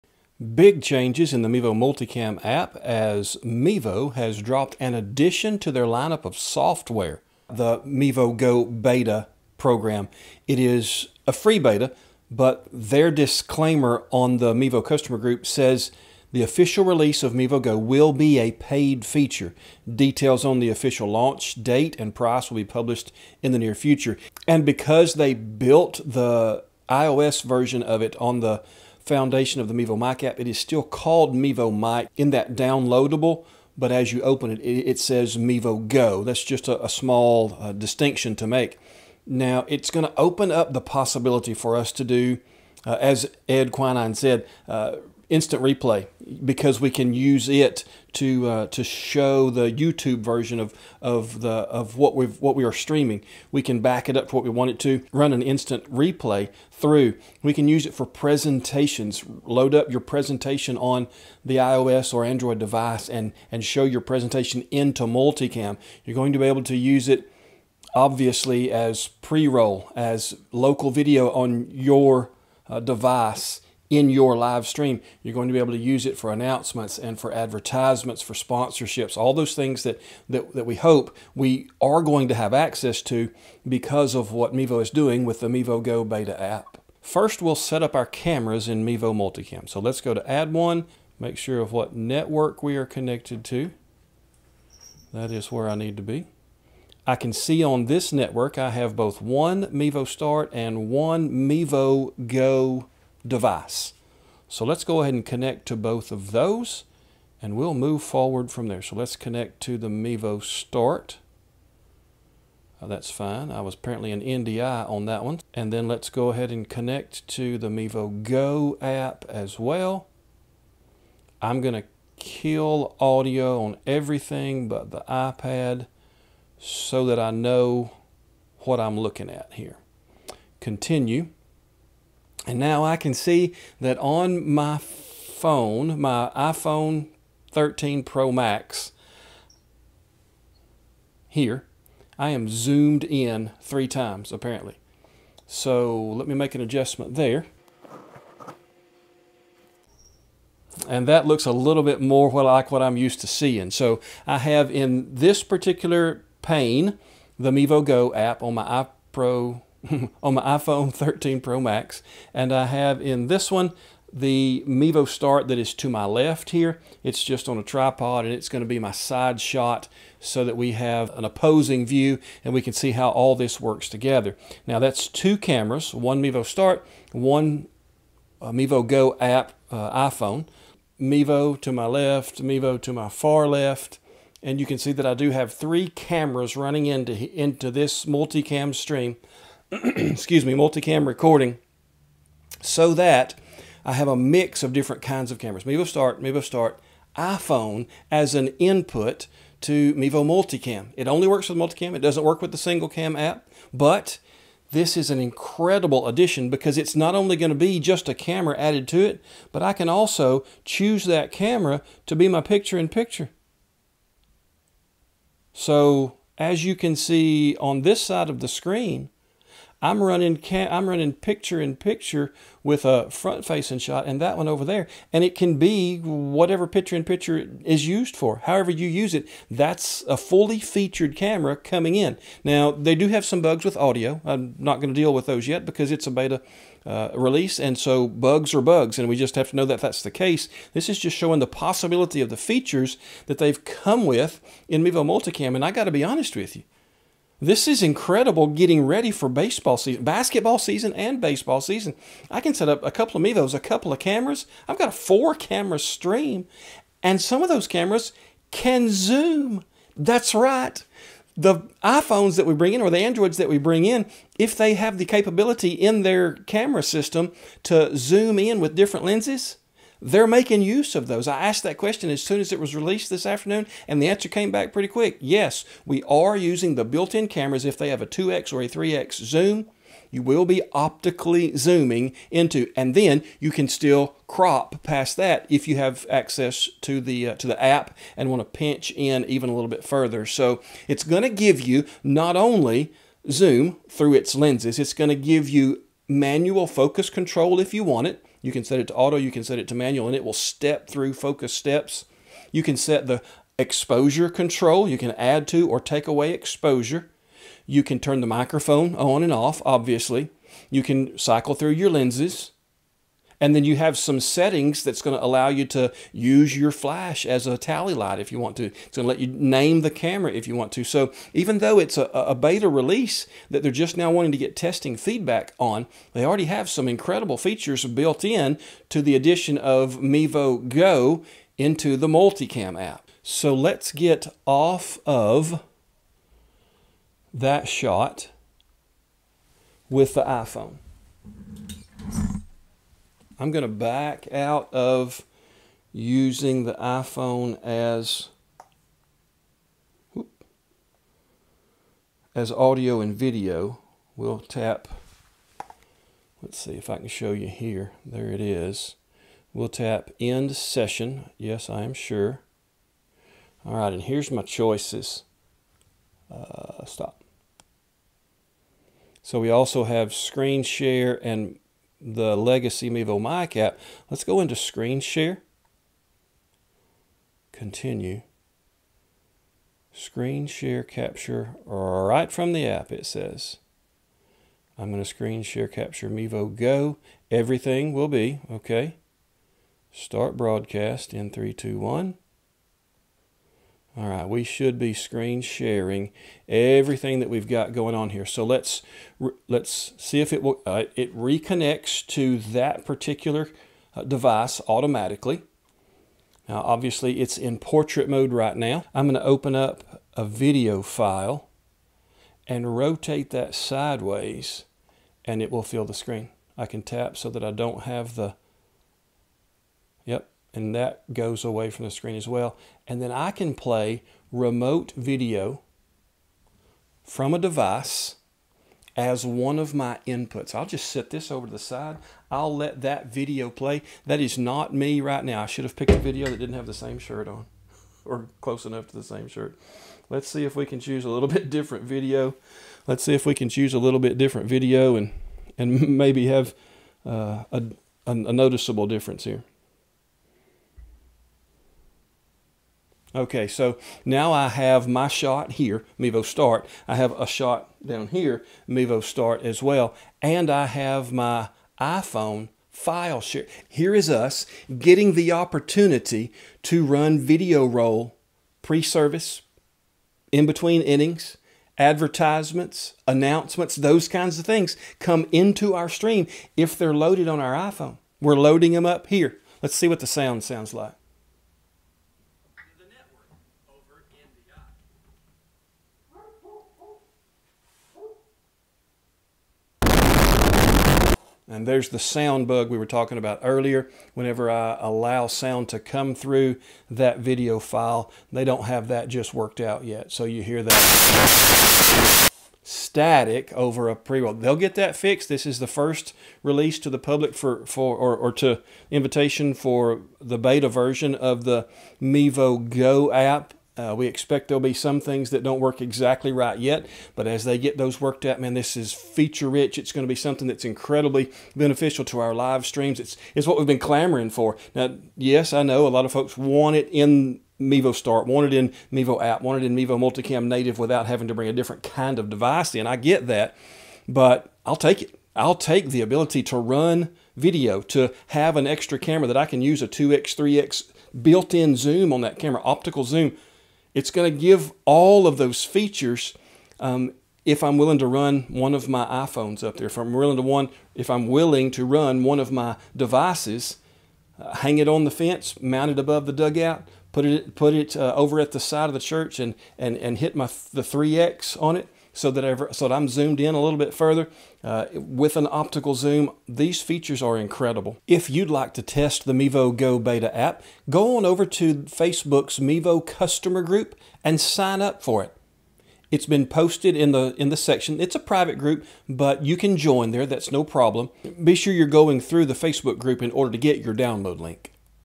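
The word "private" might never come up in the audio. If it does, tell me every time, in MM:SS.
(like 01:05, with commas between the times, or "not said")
09:38.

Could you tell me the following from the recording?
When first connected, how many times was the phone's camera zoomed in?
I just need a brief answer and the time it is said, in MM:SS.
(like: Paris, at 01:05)
3, at 02:23.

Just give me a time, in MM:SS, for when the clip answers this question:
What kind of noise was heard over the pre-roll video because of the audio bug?
08:22.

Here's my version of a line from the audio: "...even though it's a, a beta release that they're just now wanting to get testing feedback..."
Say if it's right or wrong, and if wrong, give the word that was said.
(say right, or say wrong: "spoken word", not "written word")
right.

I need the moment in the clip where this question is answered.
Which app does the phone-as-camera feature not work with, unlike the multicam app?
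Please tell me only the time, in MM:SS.
03:22.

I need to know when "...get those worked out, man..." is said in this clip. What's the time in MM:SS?
08:37.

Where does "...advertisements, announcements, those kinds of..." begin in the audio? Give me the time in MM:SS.
07:51.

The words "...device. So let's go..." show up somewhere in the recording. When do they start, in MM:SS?
01:43.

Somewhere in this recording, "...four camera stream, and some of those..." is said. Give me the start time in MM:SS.
04:14.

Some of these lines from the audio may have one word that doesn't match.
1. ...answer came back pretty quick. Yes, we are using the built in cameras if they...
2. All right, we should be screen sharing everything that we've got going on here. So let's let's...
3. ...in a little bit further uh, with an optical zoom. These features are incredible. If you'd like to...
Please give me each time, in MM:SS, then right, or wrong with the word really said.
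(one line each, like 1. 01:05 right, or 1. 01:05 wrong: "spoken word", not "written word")
1. 04:34 right
2. 06:33 right
3. 09:23 right.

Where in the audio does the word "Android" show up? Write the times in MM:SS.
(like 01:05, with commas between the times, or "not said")
01:02, 04:22.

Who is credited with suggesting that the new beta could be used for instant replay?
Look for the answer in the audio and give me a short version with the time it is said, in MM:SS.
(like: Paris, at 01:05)
Ed Quinine, at 00:43.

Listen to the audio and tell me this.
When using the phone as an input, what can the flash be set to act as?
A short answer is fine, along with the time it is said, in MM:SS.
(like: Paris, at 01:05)
Tally light, at 05:17.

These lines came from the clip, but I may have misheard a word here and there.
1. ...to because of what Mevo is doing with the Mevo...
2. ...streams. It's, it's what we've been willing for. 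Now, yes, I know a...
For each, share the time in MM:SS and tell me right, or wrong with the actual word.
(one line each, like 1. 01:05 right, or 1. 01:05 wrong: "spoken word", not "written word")
1. 01:23 right
2. 08:42 wrong: "clamoring", not "willing".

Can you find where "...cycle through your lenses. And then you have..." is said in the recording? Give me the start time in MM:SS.
05:11.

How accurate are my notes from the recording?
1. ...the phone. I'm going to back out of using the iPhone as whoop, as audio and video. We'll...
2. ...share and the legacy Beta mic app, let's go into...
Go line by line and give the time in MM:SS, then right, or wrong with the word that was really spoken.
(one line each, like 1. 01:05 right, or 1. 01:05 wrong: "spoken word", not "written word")
1. 05:40 wrong: "iPhone", not "phone"
2. 06:10 wrong: "Mevo", not "Beta".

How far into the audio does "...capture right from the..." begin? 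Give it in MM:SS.
06:20.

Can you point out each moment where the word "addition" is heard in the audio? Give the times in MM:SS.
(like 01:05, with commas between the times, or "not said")
00:04, 03:26, 05:29.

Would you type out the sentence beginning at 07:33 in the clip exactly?
Okay, so now I have my shot here, Mevo start.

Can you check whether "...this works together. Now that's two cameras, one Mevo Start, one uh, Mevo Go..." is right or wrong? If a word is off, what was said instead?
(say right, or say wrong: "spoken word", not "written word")
right.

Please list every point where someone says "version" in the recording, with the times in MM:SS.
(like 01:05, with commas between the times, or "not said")
00:27, 00:50, 08:30.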